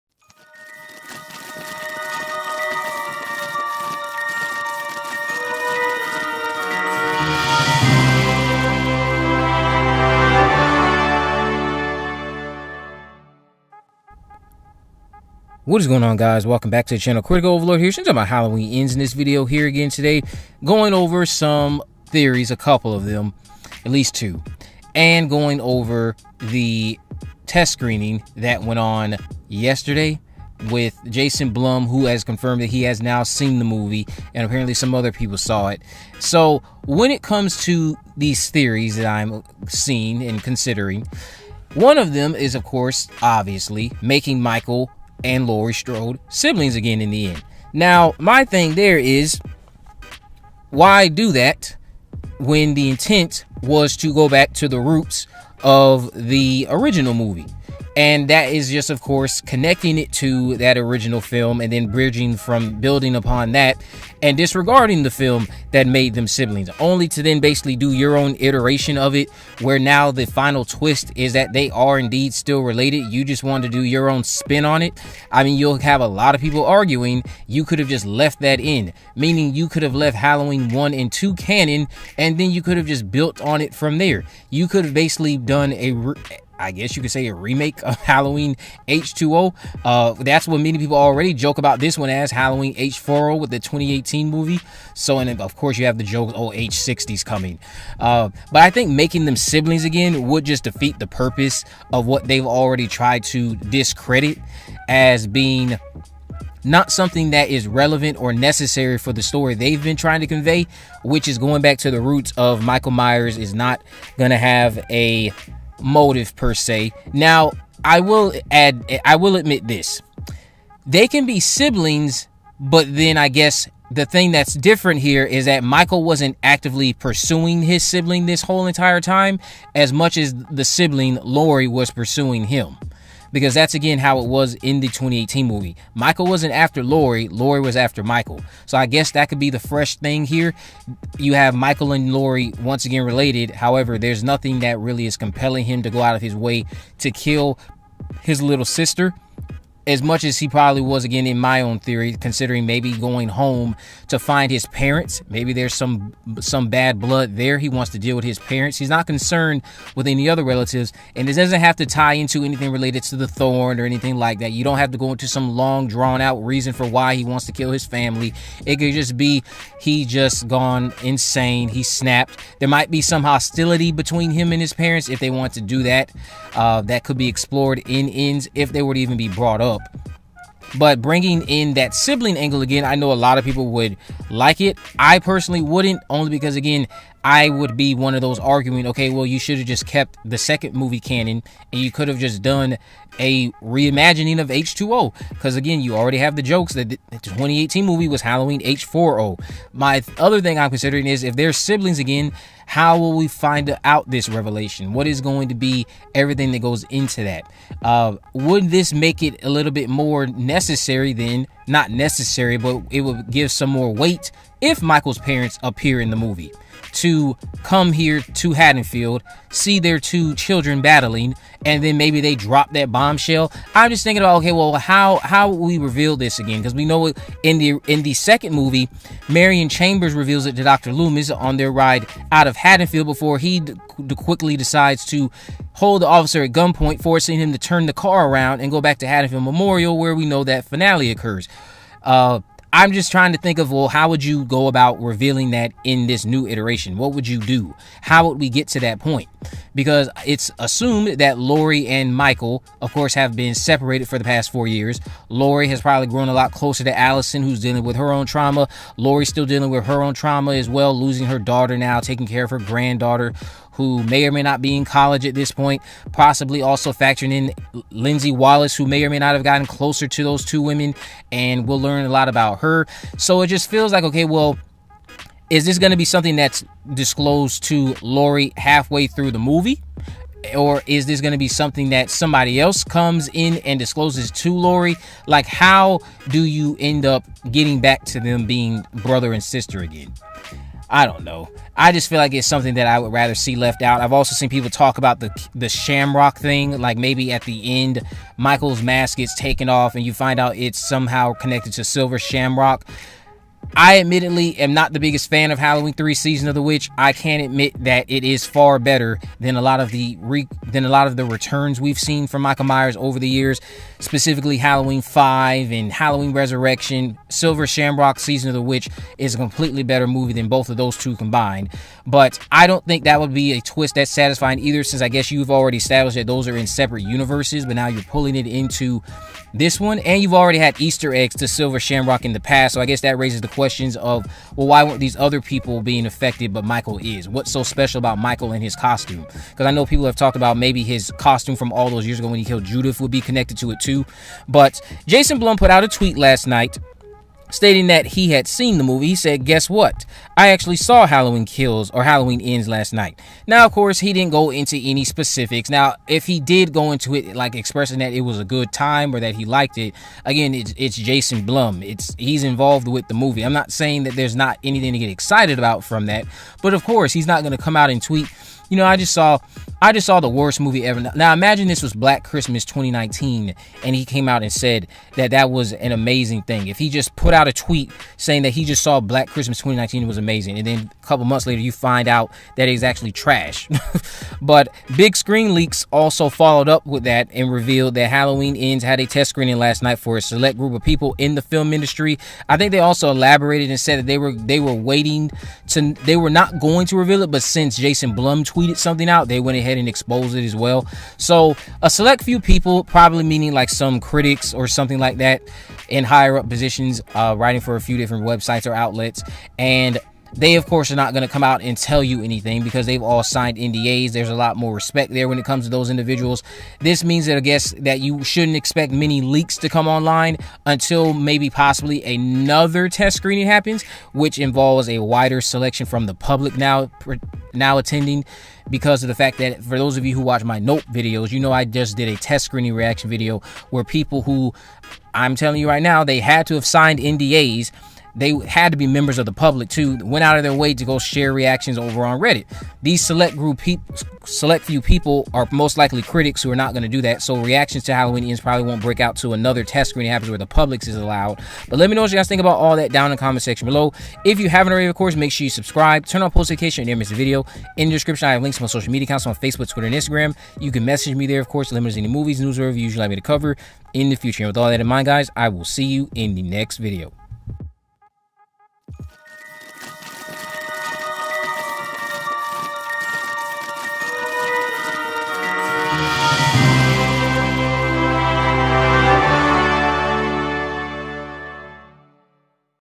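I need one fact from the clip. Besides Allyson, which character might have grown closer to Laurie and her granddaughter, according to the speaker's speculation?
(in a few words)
Lindsey Wallace.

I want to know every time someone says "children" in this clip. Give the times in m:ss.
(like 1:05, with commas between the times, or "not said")
3:40.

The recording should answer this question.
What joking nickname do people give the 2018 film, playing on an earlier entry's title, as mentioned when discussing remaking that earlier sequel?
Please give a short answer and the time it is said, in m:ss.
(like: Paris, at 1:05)
Halloween H40, at 1:32.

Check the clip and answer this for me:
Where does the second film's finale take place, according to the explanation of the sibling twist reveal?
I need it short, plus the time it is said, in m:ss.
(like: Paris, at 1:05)
Haddonfield Memorial, at 3:59.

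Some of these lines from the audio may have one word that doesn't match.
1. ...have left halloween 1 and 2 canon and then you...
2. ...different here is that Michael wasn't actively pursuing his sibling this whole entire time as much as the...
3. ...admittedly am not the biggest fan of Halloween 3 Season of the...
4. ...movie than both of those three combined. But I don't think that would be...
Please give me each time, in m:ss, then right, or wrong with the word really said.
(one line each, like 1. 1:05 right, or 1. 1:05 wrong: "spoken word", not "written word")
1. 1:19 right
2. 2:04 right
3. 5:03 right
4. 5:20 wrong: "two", not "three".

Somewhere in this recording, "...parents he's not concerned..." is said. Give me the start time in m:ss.
2:38.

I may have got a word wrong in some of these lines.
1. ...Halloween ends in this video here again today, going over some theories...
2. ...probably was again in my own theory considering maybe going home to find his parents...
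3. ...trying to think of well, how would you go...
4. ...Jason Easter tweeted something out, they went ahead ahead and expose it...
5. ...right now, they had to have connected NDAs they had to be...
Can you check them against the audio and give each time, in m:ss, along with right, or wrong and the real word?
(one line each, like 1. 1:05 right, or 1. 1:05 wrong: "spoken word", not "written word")
1. 0:18 right
2. 2:30 right
3. 4:03 right
4. 6:37 wrong: "Blum", not "Easter"
5. 7:15 wrong: "signed", not "connected".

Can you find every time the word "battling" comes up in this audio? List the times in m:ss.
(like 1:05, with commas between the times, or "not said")
3:40.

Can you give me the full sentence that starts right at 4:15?
Laurie has probably grown a lot closer to Allyson, who's dealing with her own trauma.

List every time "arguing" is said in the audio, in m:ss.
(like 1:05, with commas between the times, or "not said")
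1:16, 3:08.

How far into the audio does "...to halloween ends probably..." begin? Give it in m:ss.
7:27.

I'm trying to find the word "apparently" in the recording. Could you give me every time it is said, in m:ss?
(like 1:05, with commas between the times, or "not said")
0:34.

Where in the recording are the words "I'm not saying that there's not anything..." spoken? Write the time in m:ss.
6:03.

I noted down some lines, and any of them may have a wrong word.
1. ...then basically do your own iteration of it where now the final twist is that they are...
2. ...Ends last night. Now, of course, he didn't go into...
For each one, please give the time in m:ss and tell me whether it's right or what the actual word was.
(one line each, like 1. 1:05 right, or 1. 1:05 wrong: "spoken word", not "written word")
1. 1:07 right
2. 5:52 right.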